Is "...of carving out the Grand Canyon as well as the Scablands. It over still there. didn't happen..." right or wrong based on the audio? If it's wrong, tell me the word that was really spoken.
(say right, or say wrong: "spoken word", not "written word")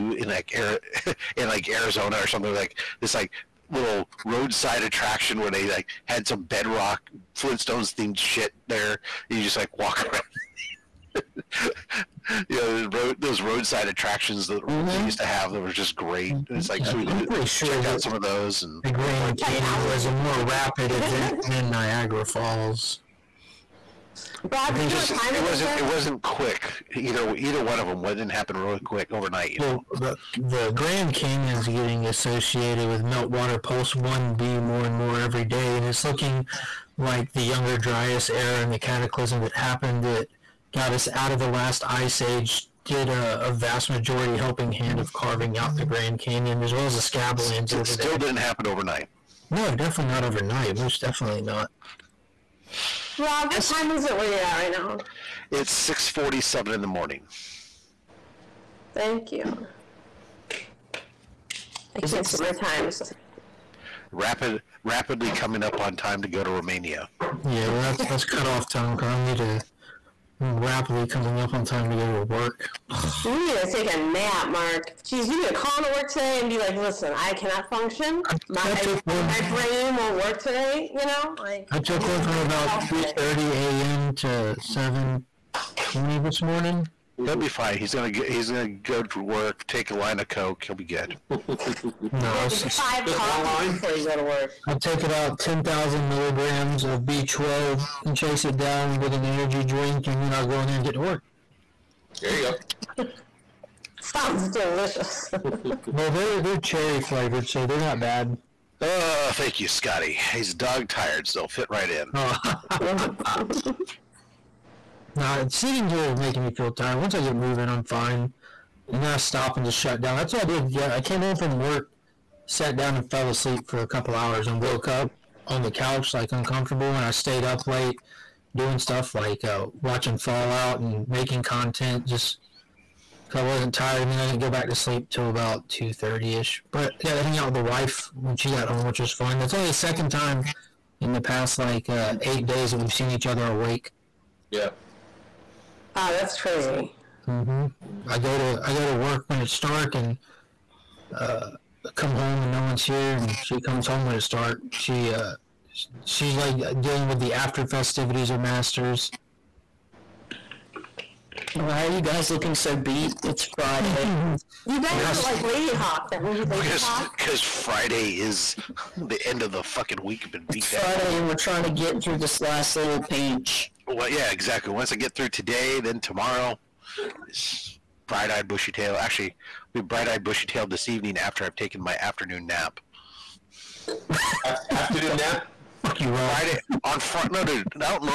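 right.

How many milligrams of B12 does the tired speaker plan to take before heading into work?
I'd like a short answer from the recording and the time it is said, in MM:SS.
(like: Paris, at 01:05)
10,000, at 01:35.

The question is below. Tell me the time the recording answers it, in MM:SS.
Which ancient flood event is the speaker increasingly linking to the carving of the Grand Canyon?
00:33.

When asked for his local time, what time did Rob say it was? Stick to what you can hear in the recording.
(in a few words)
6:47 a.m.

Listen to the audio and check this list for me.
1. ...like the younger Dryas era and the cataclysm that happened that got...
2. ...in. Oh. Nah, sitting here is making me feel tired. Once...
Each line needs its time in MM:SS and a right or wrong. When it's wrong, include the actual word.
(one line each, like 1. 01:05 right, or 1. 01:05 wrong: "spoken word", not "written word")
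1. 00:36 right
2. 01:51 right.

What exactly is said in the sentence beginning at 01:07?
Yeah, well, that's that's cut off time because I need to I'm rapidly coming up on time to go to work.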